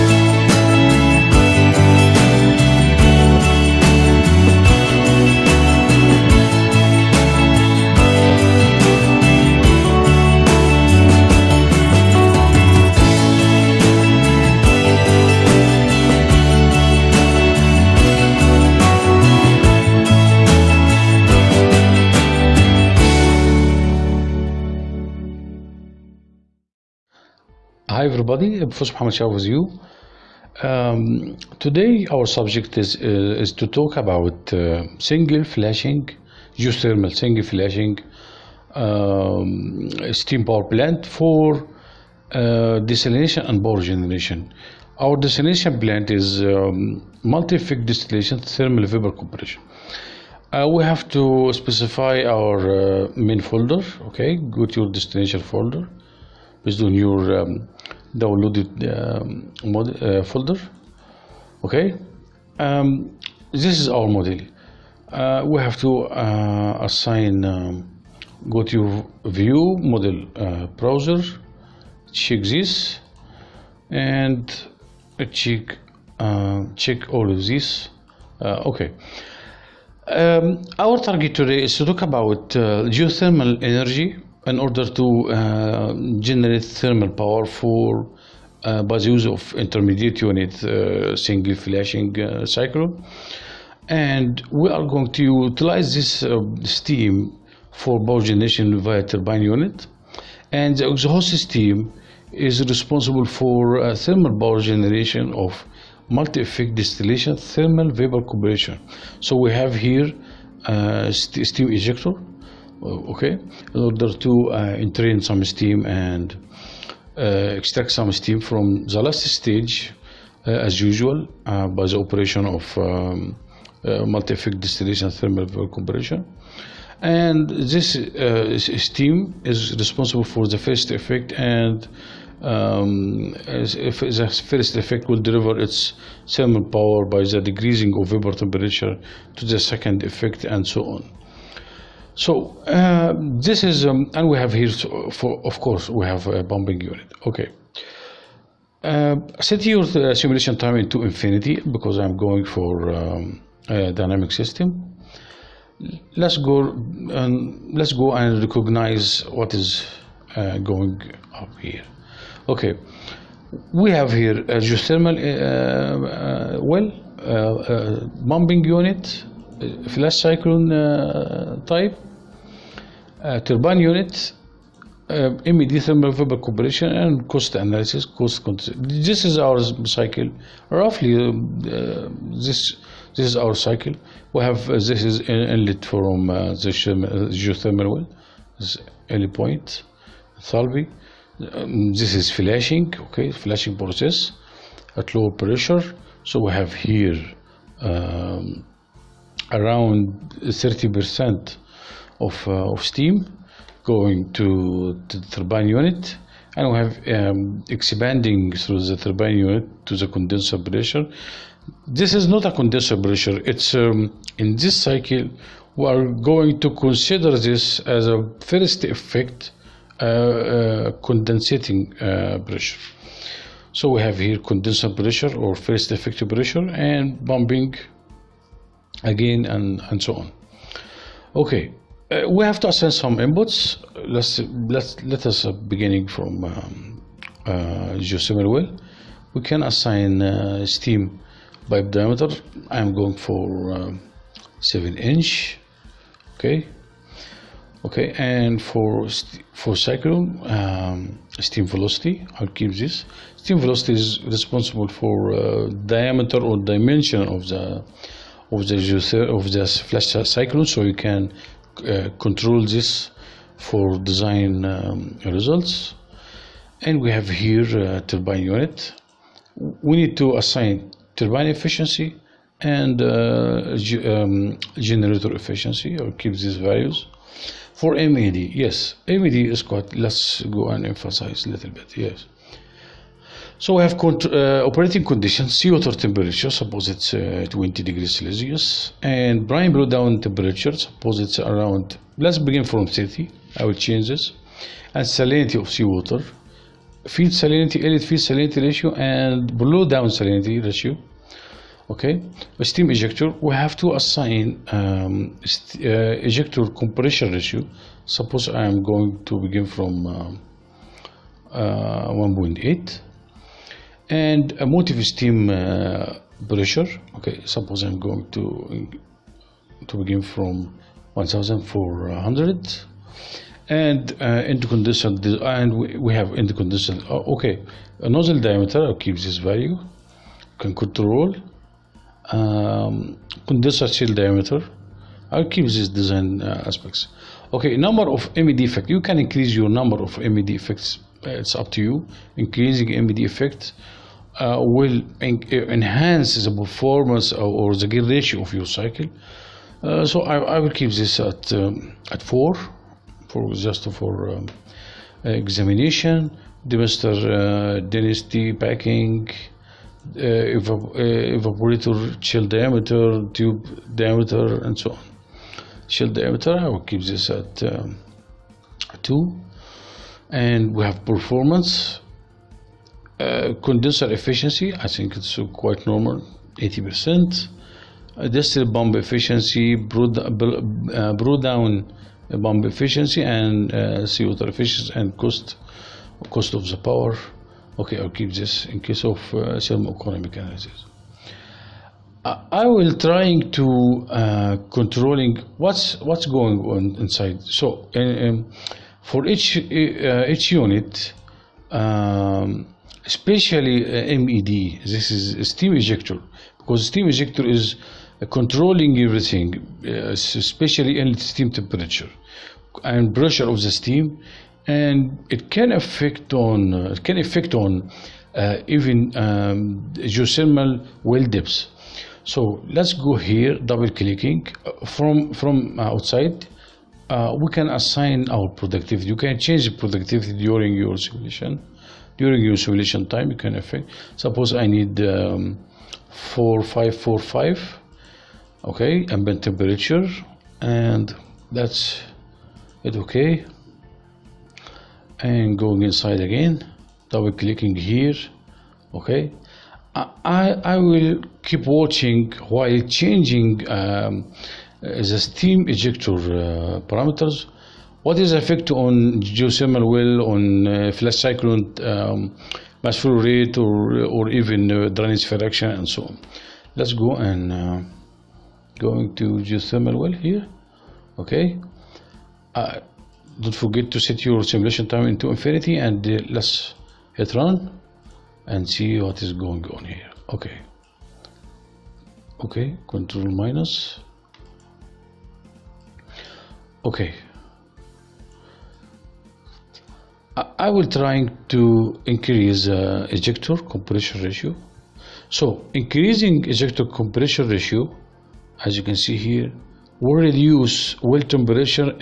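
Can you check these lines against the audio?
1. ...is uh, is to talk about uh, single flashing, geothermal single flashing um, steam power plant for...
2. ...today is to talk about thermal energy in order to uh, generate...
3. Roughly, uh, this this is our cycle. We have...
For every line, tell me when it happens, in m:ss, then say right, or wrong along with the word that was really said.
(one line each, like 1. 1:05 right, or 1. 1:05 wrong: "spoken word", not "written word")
1. 0:32 right
2. 1:21 wrong: "geothermal", not "thermal"
3. 3:00 right.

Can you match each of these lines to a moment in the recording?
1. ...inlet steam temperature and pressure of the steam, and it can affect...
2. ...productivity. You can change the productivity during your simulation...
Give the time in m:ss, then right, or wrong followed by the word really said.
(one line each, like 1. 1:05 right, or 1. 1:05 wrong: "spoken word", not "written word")
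1. 6:51 right
2. 7:08 right.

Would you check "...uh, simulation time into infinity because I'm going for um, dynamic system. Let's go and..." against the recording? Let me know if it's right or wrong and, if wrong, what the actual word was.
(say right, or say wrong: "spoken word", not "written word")
right.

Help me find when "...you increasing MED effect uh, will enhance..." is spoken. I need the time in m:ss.
5:41.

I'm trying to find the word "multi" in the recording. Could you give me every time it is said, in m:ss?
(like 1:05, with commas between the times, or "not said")
0:47, 1:46, 2:03.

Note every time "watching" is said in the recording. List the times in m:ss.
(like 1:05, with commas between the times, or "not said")
7:31.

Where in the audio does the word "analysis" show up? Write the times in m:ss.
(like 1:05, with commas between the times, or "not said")
2:57, 6:30.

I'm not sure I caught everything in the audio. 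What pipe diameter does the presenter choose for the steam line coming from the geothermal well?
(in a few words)
7 inch.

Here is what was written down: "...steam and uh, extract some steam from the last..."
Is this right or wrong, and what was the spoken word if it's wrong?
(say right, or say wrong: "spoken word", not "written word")
right.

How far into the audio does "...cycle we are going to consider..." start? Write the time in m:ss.
3:34.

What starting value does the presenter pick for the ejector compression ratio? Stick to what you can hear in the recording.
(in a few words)
1.8.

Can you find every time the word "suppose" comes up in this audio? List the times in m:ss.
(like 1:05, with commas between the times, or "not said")
4:46, 4:50, 5:08, 5:17, 7:14.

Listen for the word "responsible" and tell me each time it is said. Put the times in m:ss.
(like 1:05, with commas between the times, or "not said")
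1:42, 2:09, 4:14.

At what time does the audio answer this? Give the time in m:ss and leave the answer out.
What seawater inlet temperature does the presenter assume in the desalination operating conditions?
4:47.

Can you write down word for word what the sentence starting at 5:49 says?
Uh, so I, I, will keep this at um, at four, for just for um, examination.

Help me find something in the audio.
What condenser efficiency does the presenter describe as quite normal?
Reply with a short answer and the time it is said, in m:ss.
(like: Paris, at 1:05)
80%, at 6:16.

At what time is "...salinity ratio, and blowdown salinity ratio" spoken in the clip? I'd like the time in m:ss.
4:58.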